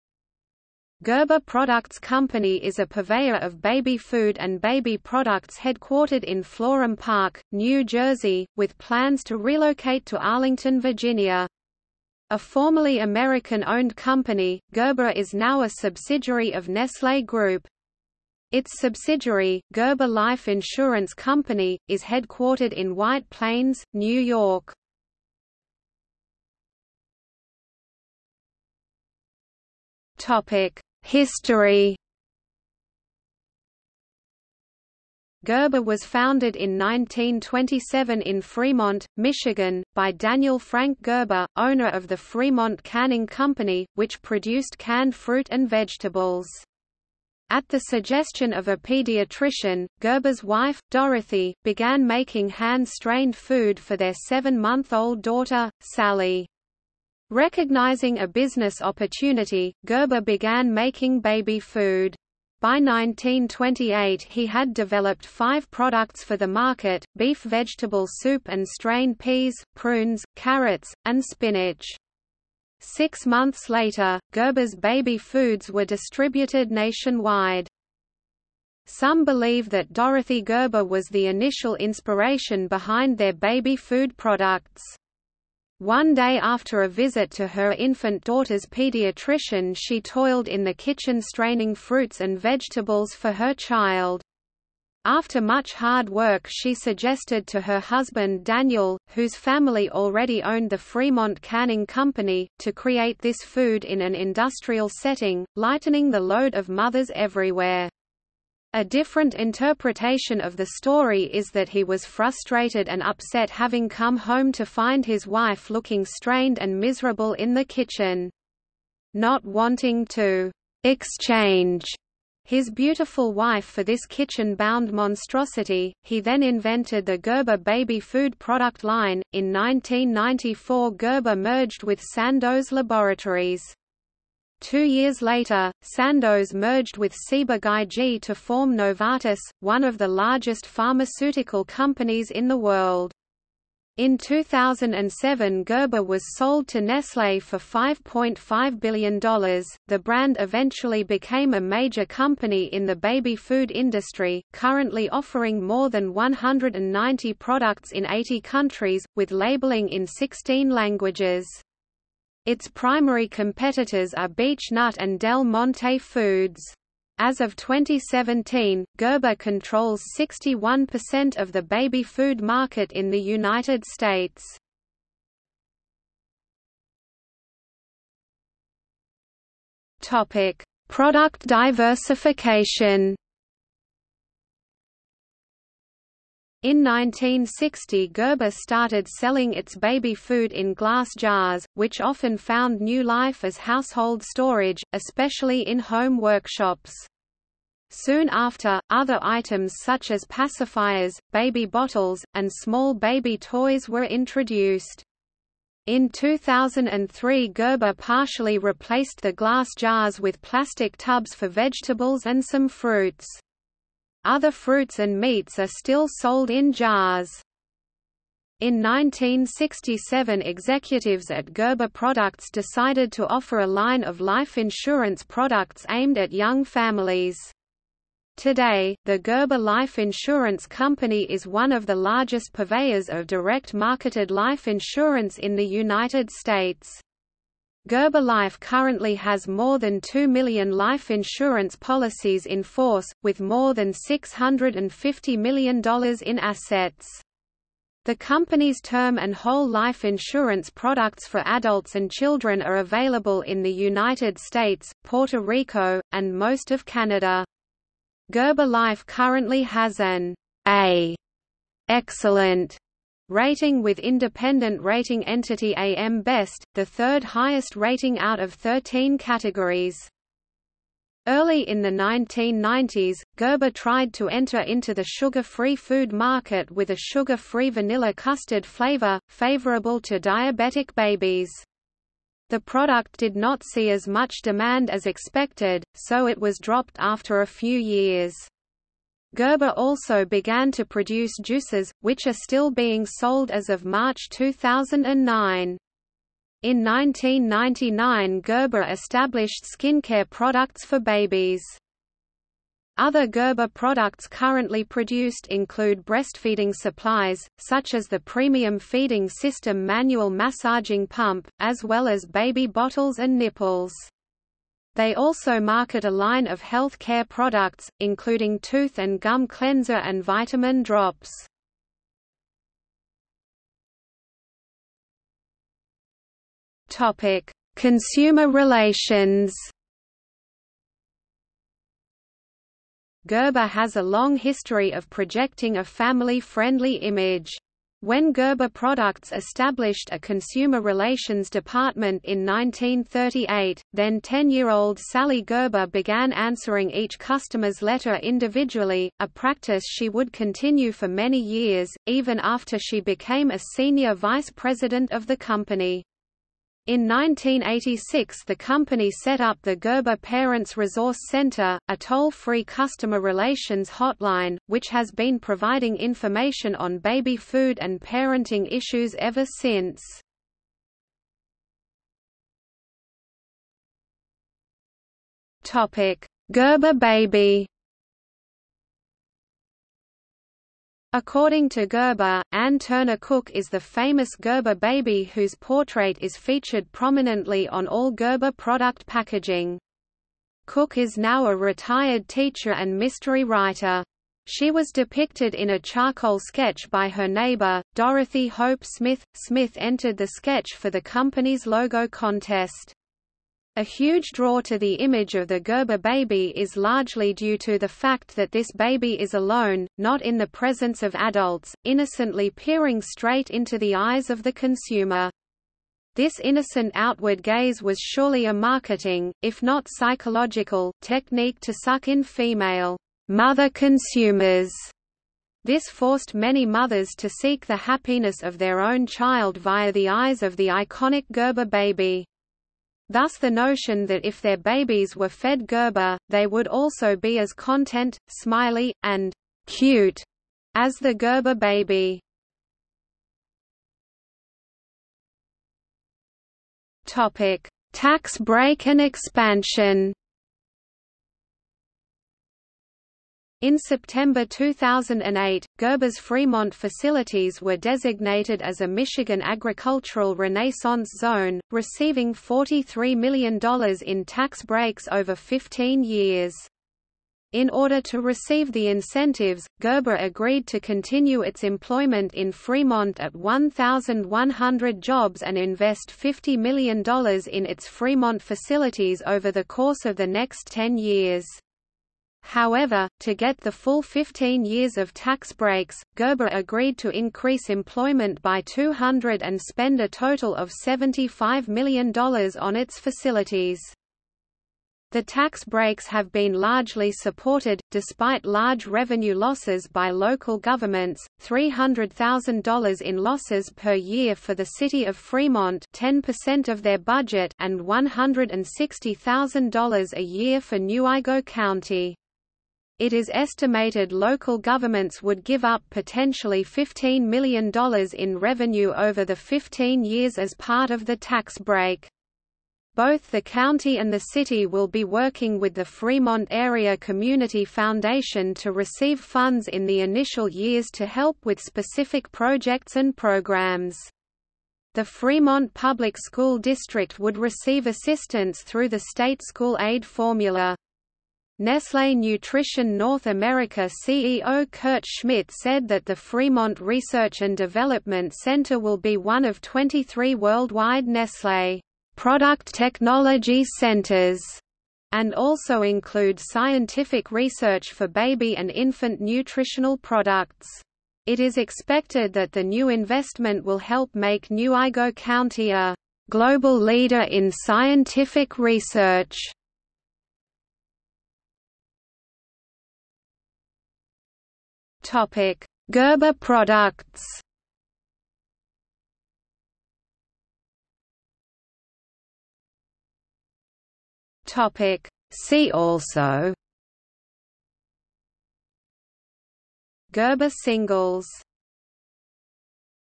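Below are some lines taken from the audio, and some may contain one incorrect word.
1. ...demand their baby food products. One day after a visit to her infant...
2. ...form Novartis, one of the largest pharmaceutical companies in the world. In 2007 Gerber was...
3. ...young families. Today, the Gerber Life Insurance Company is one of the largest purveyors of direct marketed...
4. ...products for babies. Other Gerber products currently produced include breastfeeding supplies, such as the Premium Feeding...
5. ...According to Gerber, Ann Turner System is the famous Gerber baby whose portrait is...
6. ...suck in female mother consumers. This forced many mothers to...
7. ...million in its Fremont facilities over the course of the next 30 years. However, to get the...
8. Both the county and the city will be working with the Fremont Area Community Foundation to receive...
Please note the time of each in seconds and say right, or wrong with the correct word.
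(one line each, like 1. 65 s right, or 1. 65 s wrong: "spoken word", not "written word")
1. 82 s wrong: "behind", not "demand"
2. 138 s right
3. 226 s right
4. 300 s right
5. 381 s wrong: "Cook", not "System"
6. 421 s right
7. 476 s wrong: "10", not "30"
8. 522 s right.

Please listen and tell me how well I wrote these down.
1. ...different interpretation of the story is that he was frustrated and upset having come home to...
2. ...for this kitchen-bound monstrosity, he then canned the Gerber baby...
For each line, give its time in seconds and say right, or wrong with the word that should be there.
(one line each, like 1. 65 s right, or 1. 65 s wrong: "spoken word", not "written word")
1. 108 s right
2. 123 s wrong: "invented", not "canned".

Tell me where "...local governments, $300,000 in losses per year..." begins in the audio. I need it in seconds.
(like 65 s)
500 s.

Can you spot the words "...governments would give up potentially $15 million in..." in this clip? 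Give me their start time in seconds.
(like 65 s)
514 s.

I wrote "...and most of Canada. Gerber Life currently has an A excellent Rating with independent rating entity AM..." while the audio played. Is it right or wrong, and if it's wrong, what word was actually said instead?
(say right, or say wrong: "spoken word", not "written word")
right.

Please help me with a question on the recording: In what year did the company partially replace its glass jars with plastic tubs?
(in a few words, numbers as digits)
2003.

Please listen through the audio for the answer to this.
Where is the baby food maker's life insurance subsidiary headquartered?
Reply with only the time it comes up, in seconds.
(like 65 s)
22 s.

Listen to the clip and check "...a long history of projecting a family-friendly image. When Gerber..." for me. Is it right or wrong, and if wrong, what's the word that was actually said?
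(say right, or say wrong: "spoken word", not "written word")
right.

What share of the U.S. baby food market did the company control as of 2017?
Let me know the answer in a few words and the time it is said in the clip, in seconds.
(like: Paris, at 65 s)
61%, at 170 s.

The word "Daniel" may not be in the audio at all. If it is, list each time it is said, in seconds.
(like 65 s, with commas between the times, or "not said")
40 s, 98 s.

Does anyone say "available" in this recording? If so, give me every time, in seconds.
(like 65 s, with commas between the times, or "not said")
252 s.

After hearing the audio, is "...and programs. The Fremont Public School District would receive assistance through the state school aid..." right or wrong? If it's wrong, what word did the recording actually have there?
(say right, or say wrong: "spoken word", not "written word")
right.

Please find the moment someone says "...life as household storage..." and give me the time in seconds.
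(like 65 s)
193 s.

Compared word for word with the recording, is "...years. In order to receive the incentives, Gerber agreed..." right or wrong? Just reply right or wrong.
right.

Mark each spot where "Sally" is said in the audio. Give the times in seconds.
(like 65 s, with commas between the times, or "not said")
55 s, 344 s.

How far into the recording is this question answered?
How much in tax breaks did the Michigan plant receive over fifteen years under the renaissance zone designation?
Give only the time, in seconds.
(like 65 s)
462 s.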